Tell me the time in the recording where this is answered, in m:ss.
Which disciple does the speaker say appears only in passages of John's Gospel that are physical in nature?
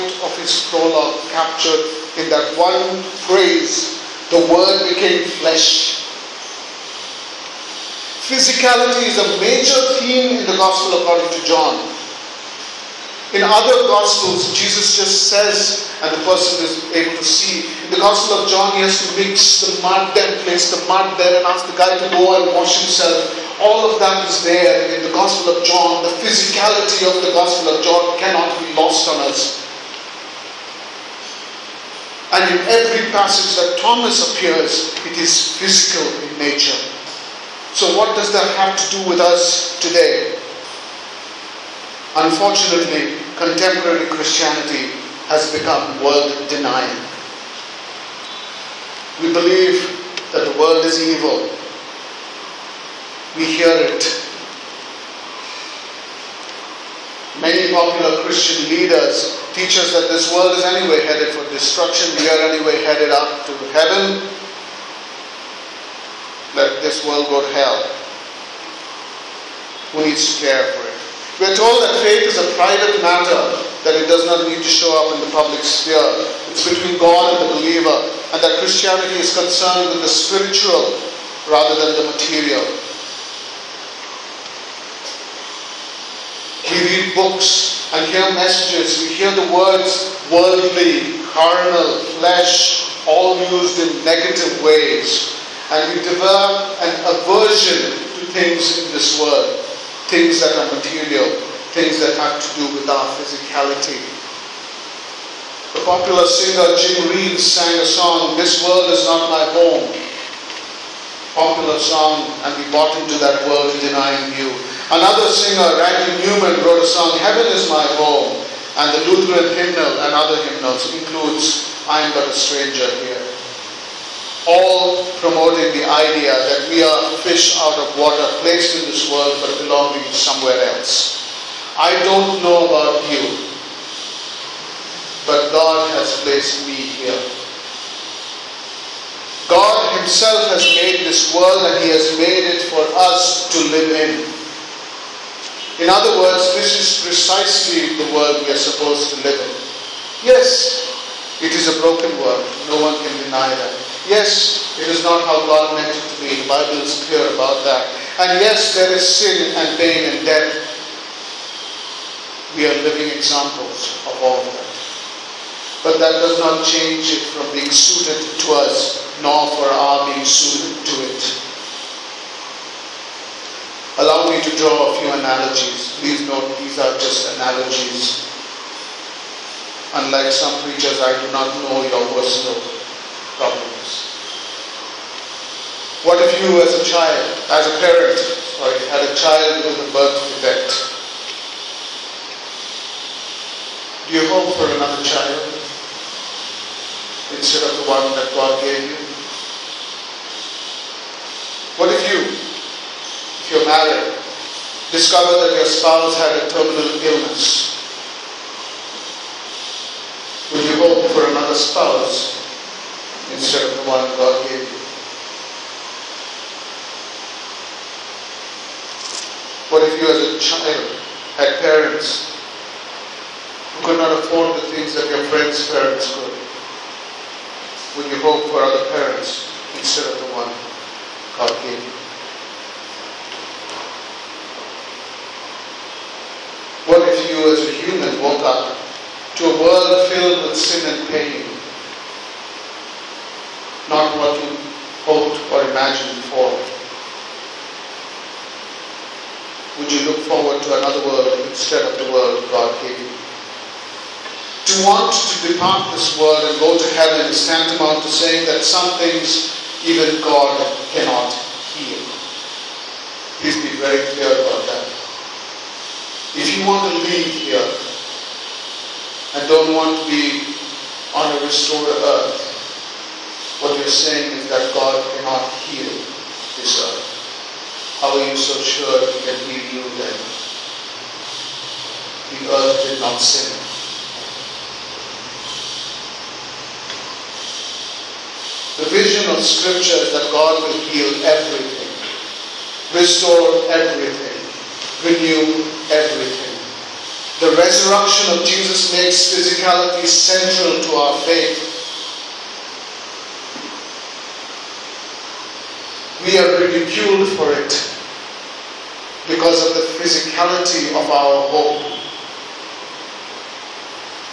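0:33.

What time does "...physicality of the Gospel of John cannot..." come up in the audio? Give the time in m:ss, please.
0:26.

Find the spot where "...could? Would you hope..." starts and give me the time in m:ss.
3:46.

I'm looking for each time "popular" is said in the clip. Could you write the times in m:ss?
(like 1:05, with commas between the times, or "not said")
0:57, 1:45, 1:51.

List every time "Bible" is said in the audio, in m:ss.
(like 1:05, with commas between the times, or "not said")
2:36.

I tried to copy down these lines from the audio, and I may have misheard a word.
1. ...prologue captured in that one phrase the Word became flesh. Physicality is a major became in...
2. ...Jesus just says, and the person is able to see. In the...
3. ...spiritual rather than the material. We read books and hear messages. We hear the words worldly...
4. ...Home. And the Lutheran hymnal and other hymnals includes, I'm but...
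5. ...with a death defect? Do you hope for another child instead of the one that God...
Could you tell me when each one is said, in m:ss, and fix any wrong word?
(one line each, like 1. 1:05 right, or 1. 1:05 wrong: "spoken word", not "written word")
1. 0:00 wrong: "theme", not "became"
2. 0:14 right
3. 1:20 right
4. 1:57 right
5. 3:09 wrong: "birth", not "death".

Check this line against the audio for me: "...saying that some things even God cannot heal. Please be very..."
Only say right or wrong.
right.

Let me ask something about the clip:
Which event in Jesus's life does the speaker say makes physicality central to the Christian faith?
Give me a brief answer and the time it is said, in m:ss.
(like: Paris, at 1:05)
the resurrection, at 4:57.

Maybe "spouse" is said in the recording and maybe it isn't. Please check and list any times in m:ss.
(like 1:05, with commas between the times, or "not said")
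3:25, 3:31.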